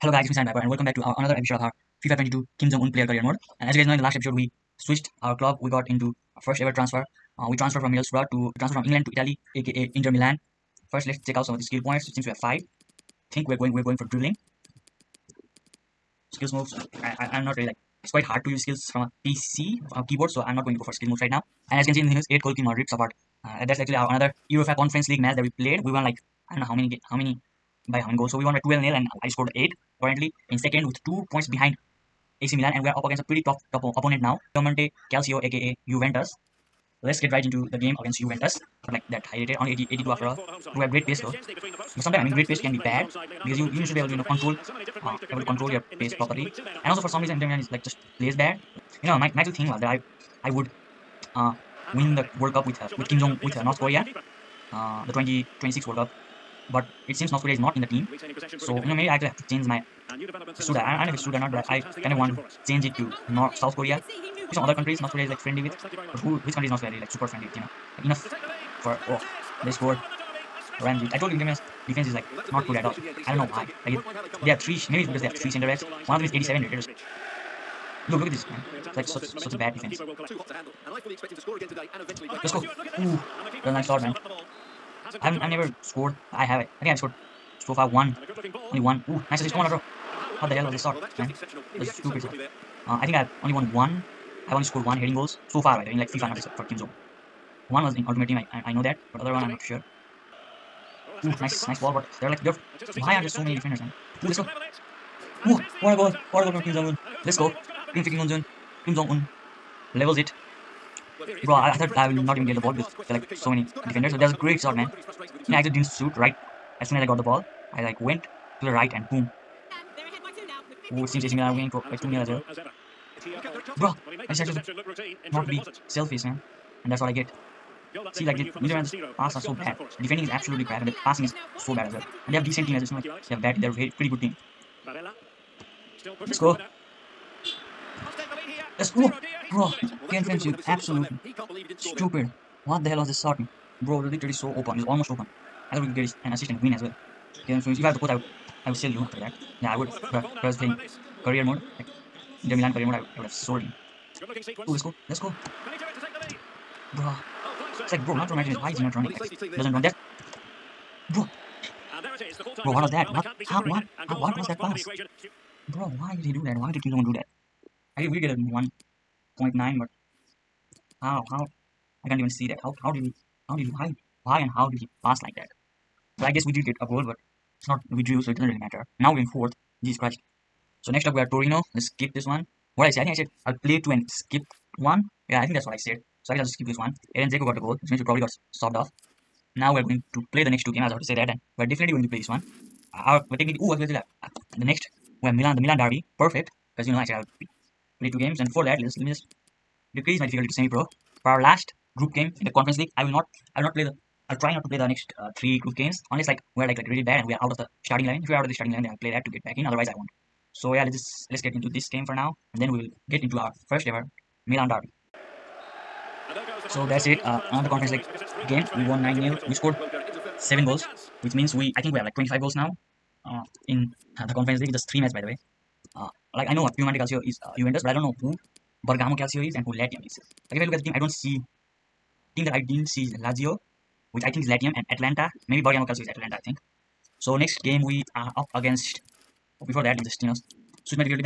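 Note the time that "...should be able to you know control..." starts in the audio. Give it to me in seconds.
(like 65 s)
43 s.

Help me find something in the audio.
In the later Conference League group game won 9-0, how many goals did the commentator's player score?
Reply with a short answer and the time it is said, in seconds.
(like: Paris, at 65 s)
7, at 220 s.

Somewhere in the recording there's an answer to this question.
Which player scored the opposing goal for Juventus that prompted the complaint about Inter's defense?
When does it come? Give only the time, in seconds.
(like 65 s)
70 s.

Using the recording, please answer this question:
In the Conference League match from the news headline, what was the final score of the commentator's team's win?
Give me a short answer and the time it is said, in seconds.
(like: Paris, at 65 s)
12-0, at 28 s.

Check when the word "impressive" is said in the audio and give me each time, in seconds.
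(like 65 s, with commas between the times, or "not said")
not said.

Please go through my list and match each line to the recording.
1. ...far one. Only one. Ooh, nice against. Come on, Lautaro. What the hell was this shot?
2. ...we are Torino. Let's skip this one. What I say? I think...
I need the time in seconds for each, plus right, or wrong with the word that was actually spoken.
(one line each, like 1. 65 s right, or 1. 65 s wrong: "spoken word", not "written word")
1. 87 s wrong: "assist", not "against"
2. 181 s right.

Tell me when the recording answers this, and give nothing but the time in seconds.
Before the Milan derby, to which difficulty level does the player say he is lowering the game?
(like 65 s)
200 s.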